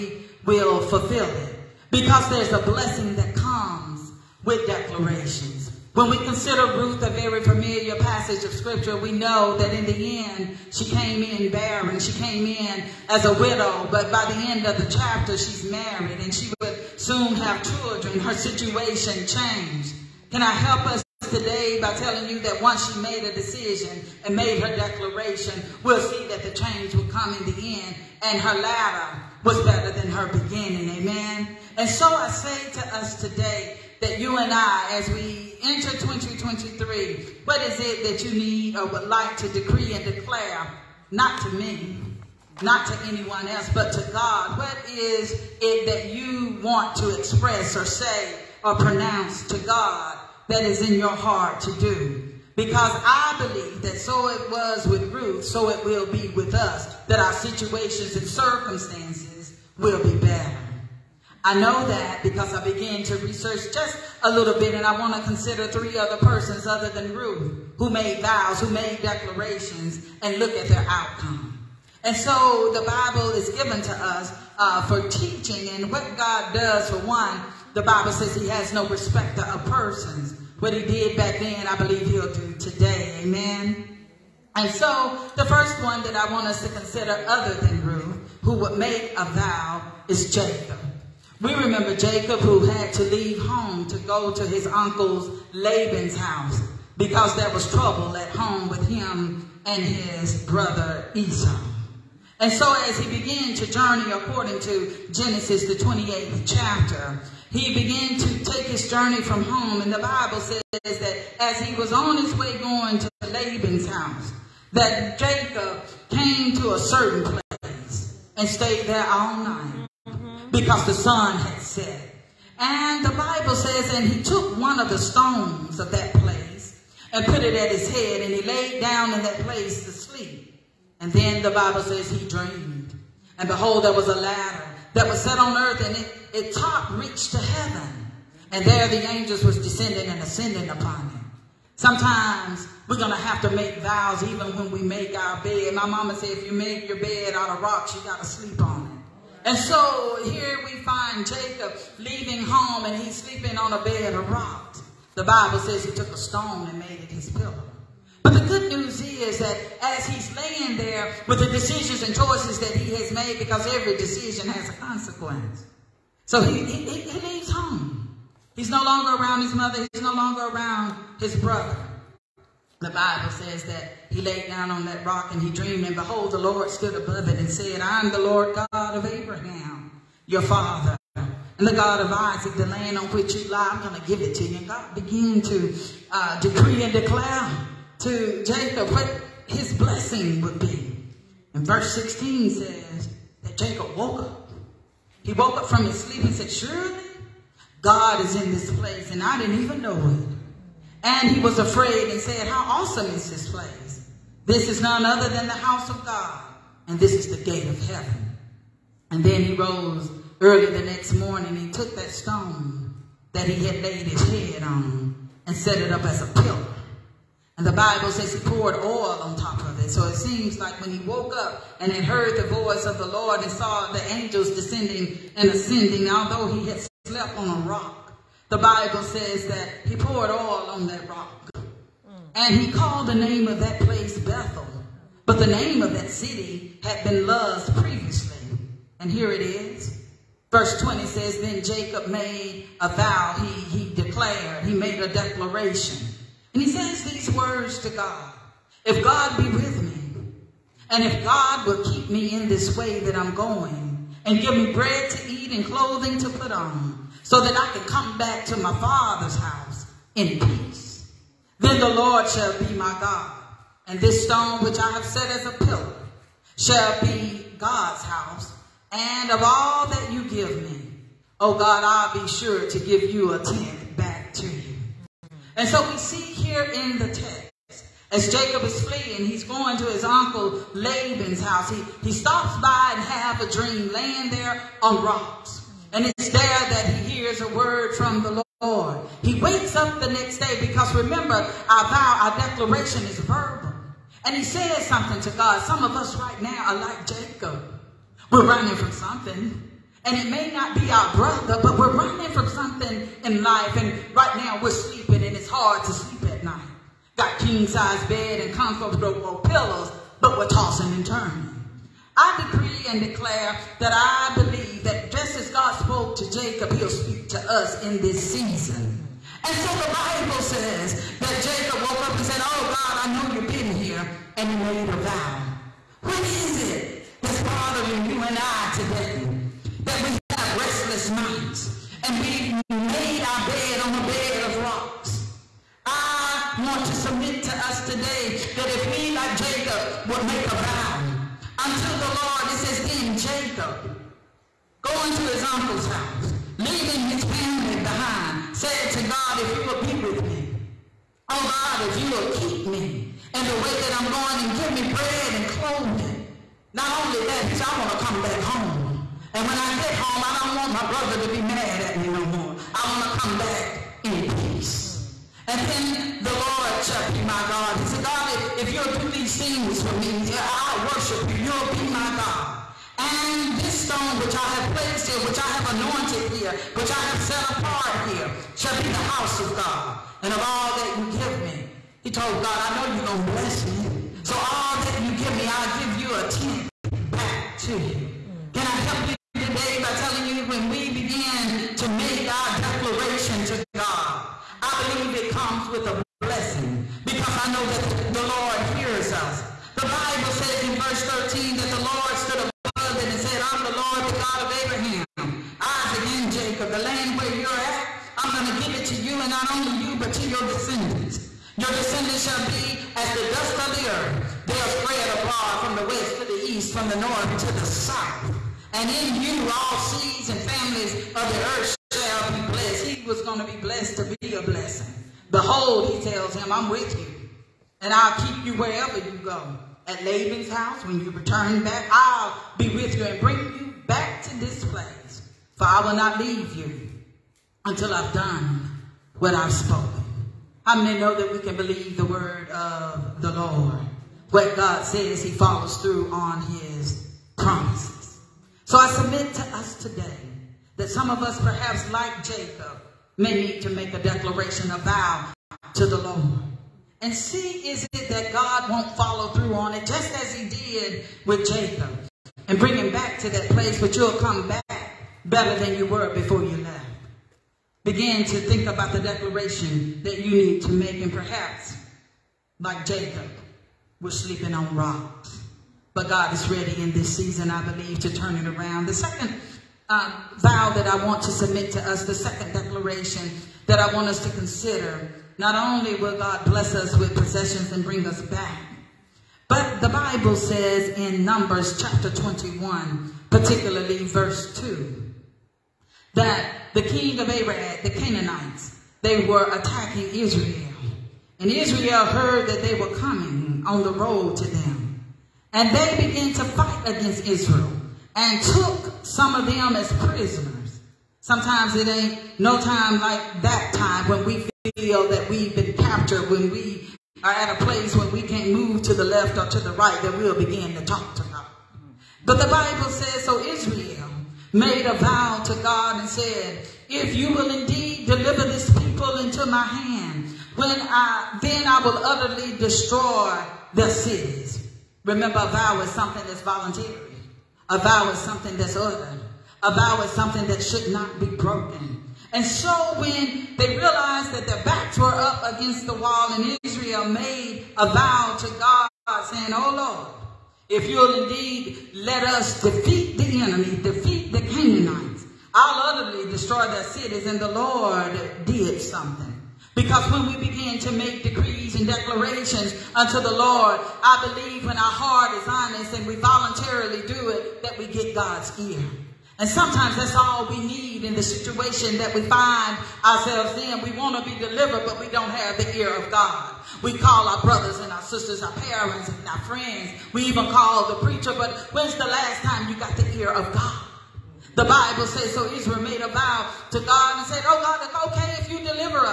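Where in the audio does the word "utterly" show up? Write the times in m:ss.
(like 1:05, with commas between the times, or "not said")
8:51, 9:16.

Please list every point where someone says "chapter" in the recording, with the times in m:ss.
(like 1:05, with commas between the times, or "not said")
0:14, 1:46, 8:11.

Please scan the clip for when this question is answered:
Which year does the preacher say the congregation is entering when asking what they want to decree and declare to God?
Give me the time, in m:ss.
0:35.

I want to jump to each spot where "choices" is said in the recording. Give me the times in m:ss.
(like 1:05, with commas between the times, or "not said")
2:42.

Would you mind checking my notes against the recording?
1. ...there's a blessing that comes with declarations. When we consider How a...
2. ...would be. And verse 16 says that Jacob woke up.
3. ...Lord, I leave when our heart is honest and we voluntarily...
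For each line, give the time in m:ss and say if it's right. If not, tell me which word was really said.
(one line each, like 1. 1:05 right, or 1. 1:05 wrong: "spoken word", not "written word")
1. 0:02 wrong: "Ruth", not "How"
2. 3:10 right
3. 9:23 wrong: "believe", not "leave".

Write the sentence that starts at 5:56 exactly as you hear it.
Not only that, he said, I want to come back home.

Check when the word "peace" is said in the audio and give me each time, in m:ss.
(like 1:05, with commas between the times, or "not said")
4:20, 6:04.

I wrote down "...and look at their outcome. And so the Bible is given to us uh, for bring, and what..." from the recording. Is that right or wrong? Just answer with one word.
wrong.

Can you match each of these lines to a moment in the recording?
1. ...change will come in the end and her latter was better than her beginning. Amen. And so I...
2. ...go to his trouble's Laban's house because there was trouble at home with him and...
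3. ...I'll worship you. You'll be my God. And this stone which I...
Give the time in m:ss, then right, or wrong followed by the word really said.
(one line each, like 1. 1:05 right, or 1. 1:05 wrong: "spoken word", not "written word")
1. 0:26 right
2. 1:33 wrong: "uncle", not "trouble"
3. 6:10 right.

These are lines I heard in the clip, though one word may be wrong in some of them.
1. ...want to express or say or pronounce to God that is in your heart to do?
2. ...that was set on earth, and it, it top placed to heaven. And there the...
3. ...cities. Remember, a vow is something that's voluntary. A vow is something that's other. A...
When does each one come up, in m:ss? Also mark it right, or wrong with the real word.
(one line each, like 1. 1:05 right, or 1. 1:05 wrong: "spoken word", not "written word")
1. 0:46 right
2. 2:14 wrong: "reached", not "placed"
3. 8:53 right.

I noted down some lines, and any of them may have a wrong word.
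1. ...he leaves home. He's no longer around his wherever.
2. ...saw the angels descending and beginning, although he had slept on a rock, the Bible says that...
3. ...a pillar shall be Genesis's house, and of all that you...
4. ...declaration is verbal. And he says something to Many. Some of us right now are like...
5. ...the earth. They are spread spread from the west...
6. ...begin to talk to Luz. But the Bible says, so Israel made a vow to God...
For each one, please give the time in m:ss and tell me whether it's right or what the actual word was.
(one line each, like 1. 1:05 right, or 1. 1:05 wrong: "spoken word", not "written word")
1. 2:47 wrong: "mother", not "wherever"
2. 3:43 wrong: "ascending", not "beginning"
3. 4:25 wrong: "God", not "Genesis"
4. 4:52 wrong: "God", not "Many"
5. 6:53 wrong: "abroad", not "spread"
6. 8:40 wrong: "God", not "Luz".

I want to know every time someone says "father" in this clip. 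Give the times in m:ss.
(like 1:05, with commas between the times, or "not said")
3:00, 4:18.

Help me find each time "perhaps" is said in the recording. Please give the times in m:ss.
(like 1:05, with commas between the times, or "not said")
7:31, 7:51.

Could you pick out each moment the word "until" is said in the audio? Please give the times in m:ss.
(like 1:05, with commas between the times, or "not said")
5:41, 7:17.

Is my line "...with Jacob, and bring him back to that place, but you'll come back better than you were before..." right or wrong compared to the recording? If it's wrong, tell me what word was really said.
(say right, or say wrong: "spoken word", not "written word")
right.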